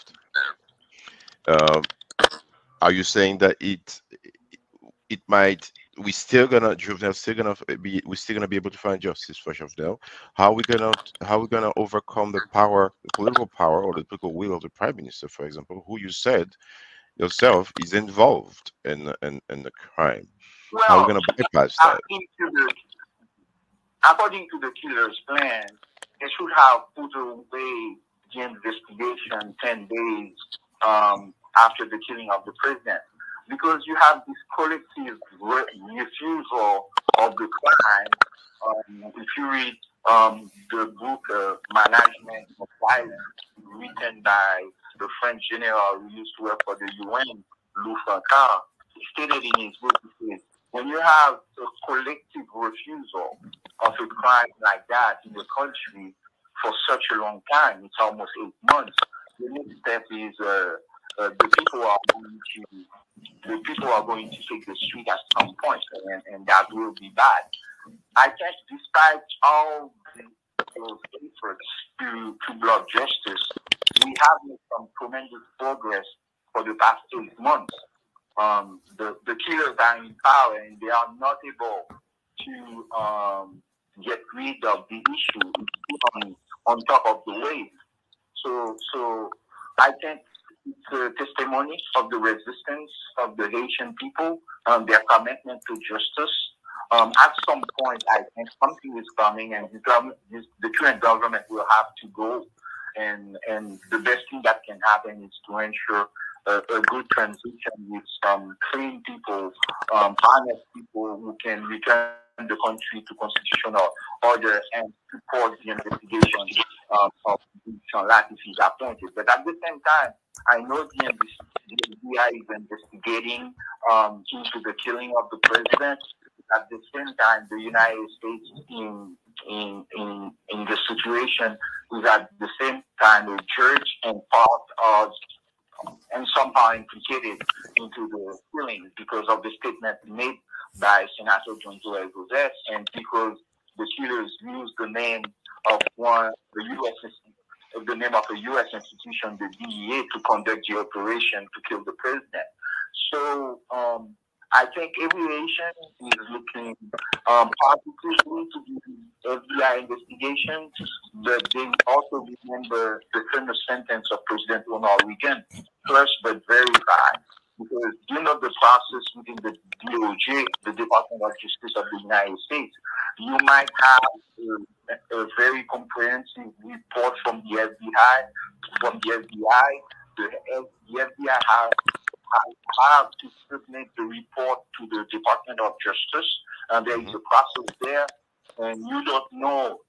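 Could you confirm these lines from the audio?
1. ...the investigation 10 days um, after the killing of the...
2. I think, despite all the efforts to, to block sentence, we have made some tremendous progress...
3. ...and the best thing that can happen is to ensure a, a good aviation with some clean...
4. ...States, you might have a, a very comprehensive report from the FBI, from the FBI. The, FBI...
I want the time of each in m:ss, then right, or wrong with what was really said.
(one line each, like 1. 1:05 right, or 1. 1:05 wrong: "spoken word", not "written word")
1. 0:28 right
2. 1:08 wrong: "justice", not "sentence"
3. 1:43 wrong: "transition", not "aviation"
4. 2:52 right.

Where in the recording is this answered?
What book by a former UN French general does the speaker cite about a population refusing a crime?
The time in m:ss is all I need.
0:41.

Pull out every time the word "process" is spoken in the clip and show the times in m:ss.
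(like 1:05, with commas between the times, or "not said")
2:48, 3:07.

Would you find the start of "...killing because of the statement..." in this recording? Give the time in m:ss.
2:18.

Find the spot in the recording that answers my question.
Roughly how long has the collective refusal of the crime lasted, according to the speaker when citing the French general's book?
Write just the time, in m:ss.
0:57.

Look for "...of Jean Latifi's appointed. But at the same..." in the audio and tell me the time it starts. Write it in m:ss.
1:57.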